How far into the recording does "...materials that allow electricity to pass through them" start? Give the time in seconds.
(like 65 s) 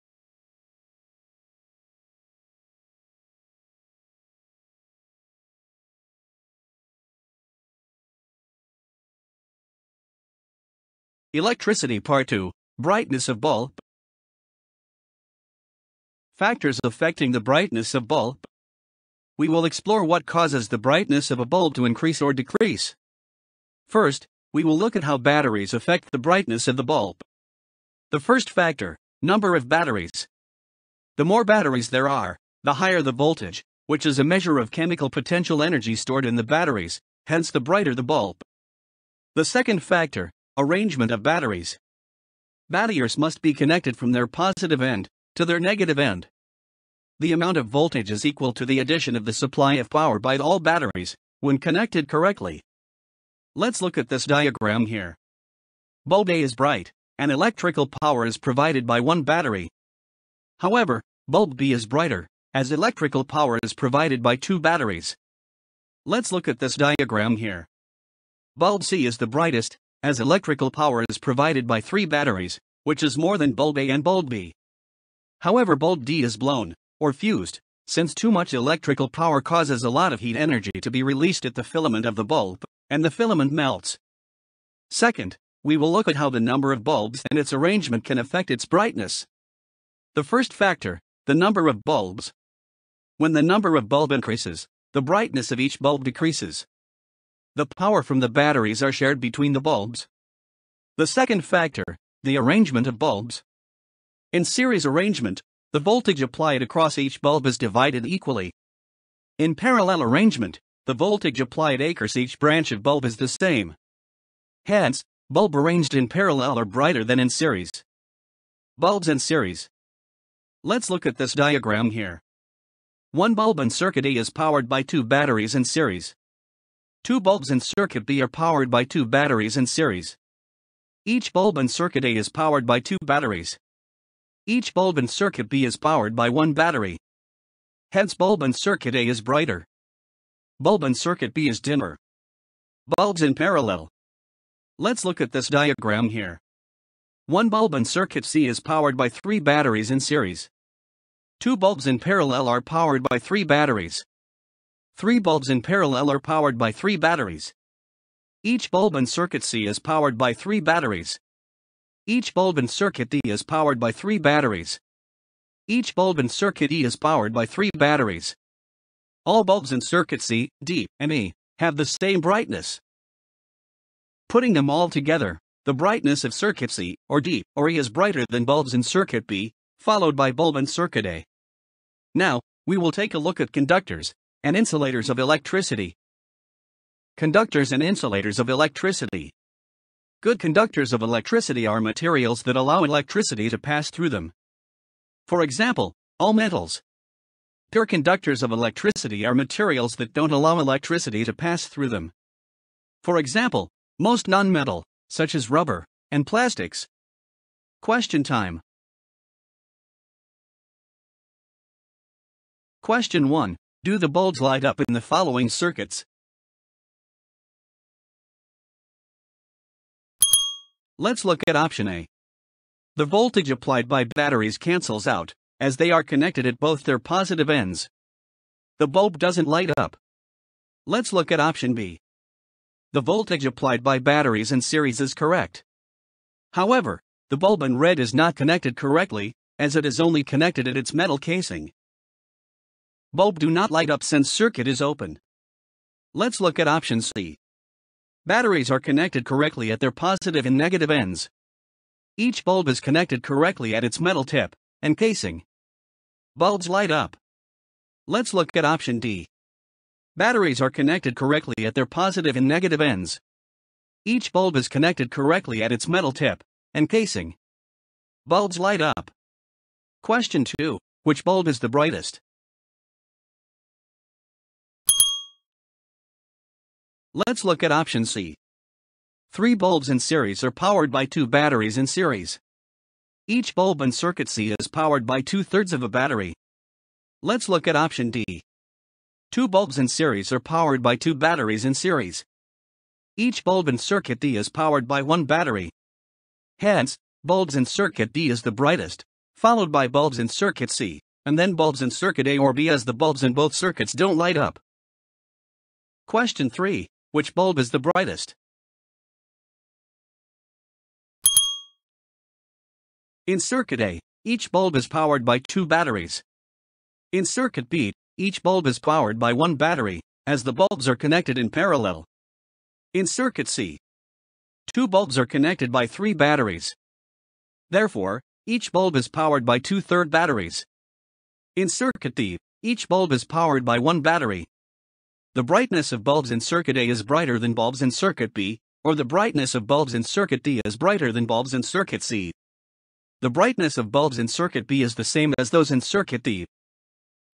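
191 s.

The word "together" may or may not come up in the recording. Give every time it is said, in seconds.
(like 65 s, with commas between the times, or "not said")
174 s.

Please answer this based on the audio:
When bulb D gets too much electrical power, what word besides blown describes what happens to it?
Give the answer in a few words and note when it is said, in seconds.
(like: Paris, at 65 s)
fused, at 77 s.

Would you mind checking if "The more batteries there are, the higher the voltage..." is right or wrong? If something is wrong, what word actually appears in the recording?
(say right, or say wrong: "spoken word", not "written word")
right.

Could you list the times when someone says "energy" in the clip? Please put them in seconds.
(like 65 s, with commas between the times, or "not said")
35 s, 80 s.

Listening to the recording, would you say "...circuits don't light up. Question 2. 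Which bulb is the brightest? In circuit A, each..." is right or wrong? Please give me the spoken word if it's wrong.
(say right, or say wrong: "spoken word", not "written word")
wrong: "3", not "2".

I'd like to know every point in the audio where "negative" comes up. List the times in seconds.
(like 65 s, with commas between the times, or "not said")
45 s, 250 s, 262 s.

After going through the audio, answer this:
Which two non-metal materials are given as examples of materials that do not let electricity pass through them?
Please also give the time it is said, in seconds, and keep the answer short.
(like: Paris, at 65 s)
rubber and plastics, at 205 s.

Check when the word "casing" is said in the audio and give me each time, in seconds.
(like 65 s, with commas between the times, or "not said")
241 s, 254 s, 266 s.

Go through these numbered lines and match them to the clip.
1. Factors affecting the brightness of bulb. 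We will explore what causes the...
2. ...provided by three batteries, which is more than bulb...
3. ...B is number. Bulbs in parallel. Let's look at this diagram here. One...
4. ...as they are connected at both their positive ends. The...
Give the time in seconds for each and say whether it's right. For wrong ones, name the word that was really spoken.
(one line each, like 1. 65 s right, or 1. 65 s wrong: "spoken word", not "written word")
1. 16 s right
2. 71 s right
3. 141 s wrong: "dimmer", not "number"
4. 225 s right.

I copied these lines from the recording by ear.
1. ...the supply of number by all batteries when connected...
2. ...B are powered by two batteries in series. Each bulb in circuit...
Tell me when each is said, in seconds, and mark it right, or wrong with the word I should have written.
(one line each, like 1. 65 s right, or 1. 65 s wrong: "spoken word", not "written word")
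1. 49 s wrong: "power", not "number"
2. 128 s right.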